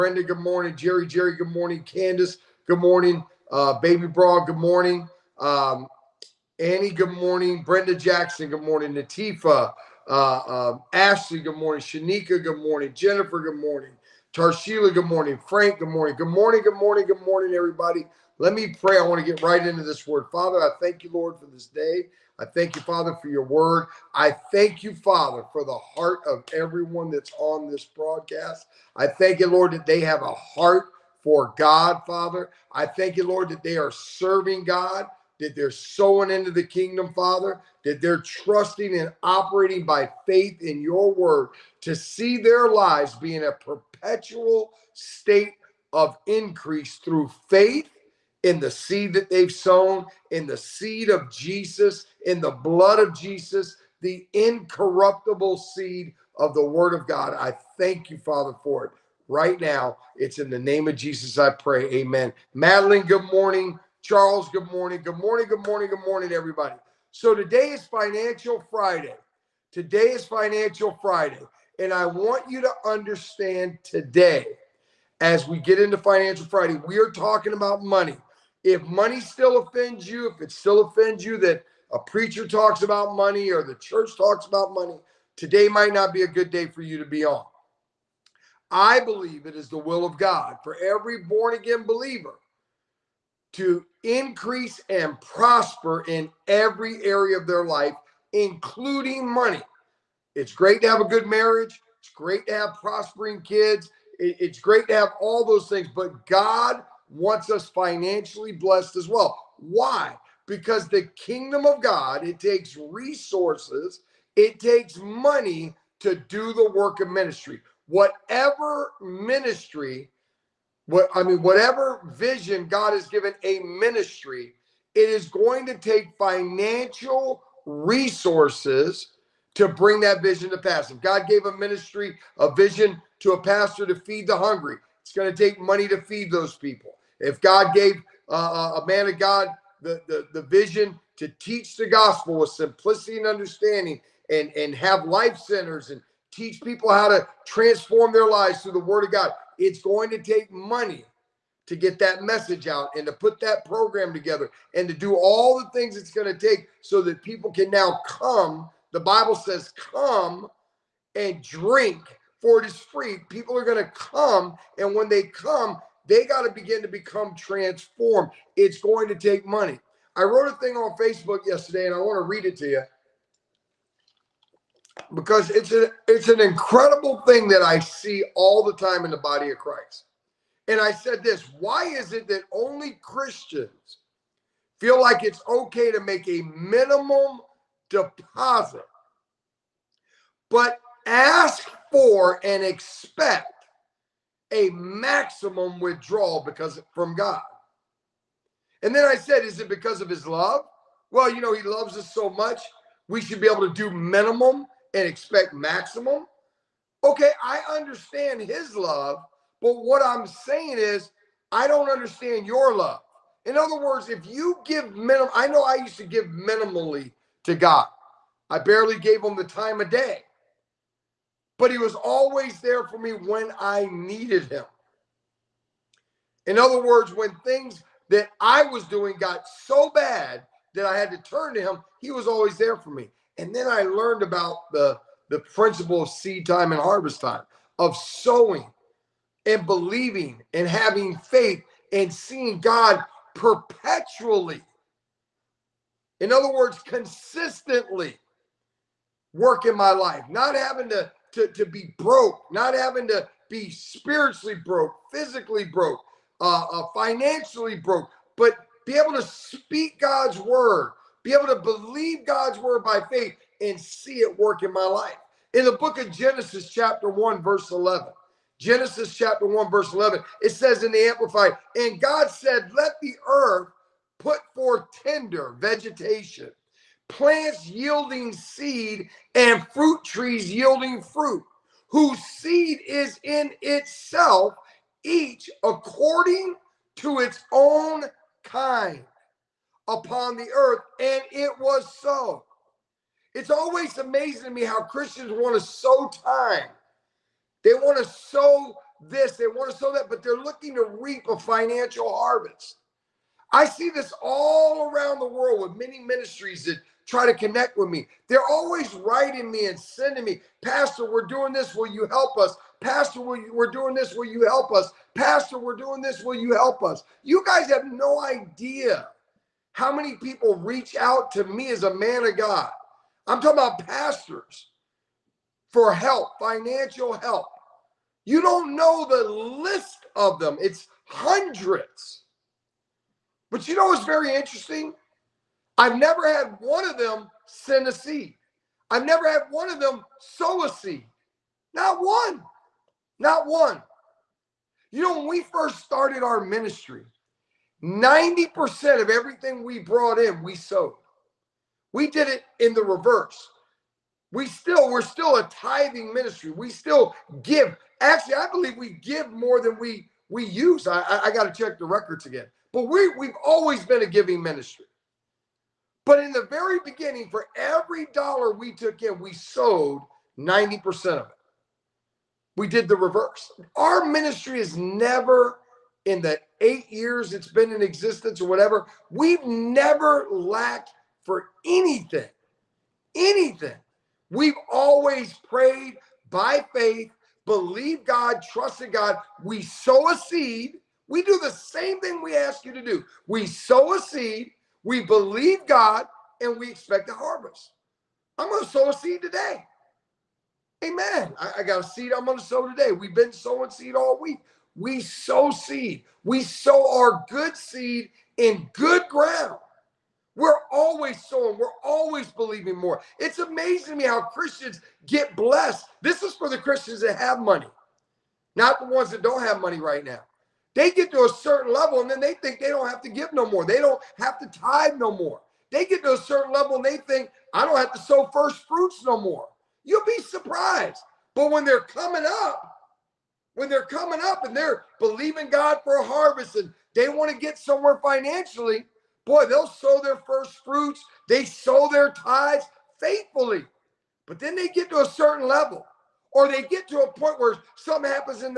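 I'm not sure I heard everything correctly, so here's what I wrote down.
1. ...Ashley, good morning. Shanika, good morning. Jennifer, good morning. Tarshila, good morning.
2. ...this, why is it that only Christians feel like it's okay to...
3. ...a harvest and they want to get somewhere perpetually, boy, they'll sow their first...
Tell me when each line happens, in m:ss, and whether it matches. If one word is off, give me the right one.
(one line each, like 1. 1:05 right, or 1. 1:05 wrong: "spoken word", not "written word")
1. 0:10 right
2. 3:01 right
3. 7:15 wrong: "financially", not "perpetually".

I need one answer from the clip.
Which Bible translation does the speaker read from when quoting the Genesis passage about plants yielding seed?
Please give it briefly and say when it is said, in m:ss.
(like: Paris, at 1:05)
Amplified, at 4:31.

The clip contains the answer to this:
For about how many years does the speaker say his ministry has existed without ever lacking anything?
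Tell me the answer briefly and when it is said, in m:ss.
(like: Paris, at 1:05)
8, at 6:16.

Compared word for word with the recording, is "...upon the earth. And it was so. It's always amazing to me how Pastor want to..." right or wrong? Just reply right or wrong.
wrong.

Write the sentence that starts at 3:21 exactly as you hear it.
Well, you know, he loves us so much, we should be able to do minimum and expect maximum.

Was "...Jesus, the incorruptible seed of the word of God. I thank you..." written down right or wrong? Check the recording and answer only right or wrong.
right.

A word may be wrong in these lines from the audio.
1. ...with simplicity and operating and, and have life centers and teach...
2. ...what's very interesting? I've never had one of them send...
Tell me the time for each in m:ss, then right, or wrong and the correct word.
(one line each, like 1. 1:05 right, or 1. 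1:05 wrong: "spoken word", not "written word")
1. 2:22 wrong: "understanding", not "operating"
2. 5:33 right.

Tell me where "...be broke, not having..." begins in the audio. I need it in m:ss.
4:11.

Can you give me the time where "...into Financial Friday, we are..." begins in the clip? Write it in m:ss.
1:15.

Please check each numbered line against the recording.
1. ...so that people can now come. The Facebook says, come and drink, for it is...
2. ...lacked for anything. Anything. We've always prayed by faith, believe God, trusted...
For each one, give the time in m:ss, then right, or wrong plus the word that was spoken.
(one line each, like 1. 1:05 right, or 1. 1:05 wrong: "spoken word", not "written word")
1. 2:36 wrong: "Bible", not "Facebook"
2. 6:20 right.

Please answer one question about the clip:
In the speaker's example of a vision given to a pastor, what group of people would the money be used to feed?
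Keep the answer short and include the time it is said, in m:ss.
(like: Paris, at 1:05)
the hungry, at 2:14.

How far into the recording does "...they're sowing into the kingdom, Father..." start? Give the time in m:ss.
0:35.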